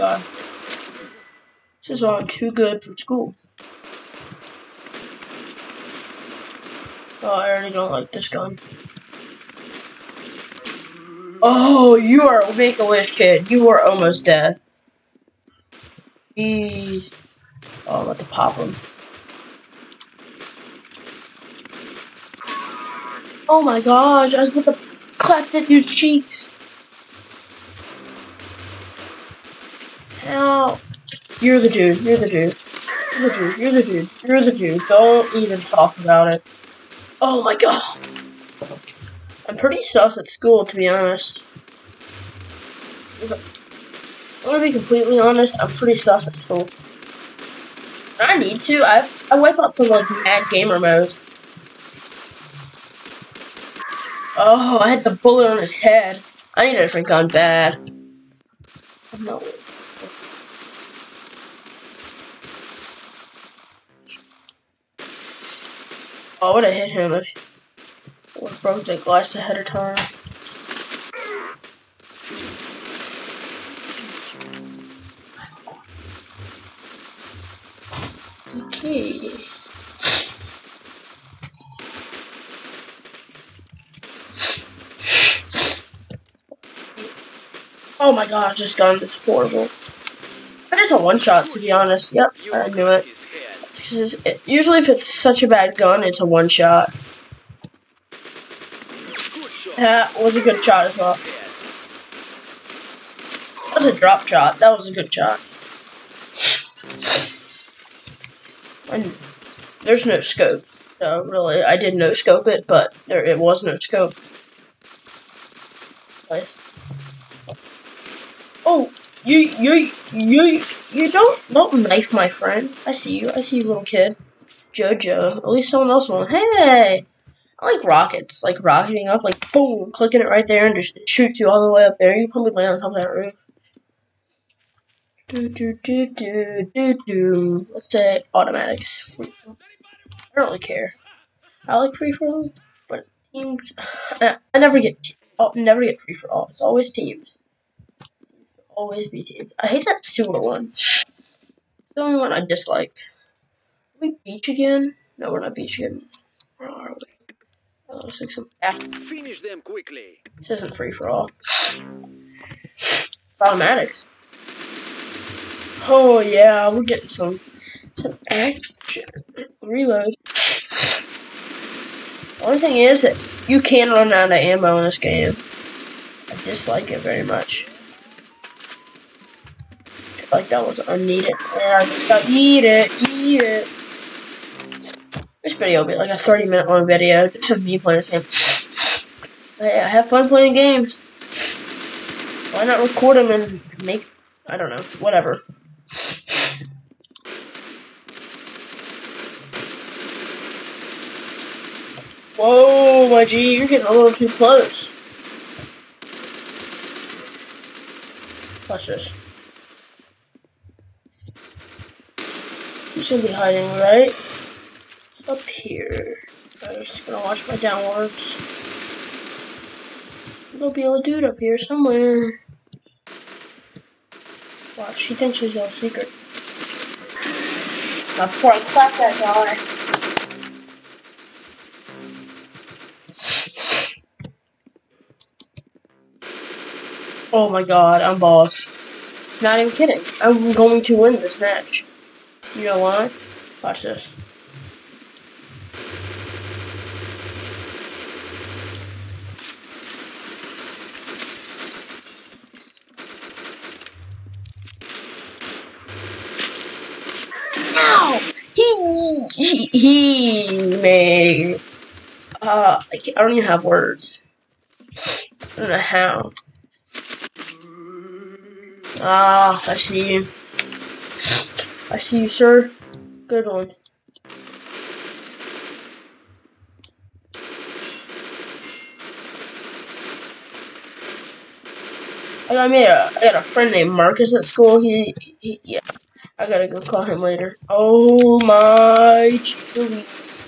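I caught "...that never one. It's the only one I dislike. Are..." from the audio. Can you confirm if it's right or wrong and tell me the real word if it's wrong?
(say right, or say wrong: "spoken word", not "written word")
wrong: "silver", not "never".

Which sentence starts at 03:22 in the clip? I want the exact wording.
Whoa, my G, you're getting a little too close.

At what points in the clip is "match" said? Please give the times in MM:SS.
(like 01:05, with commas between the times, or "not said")
04:01.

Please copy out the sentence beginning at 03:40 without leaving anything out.
There'll be a dude up here somewhere.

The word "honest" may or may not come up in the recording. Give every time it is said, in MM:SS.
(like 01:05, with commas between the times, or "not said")
00:40, 00:45, 01:31.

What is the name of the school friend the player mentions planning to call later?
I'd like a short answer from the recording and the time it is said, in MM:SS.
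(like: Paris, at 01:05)
Marcus, at 04:43.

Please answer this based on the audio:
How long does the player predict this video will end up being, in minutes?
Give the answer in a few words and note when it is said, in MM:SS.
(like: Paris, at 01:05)
30, at 03:06.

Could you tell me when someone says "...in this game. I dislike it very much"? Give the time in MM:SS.
02:54.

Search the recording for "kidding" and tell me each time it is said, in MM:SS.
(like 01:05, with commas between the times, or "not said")
03:59.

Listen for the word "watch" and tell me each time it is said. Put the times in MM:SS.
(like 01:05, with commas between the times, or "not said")
03:28, 03:37, 03:44, 04:03.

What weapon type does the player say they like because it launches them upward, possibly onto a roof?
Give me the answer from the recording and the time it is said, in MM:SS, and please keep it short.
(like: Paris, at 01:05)
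Rockets, at 02:07.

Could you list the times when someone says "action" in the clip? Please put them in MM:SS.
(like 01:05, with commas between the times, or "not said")
02:48.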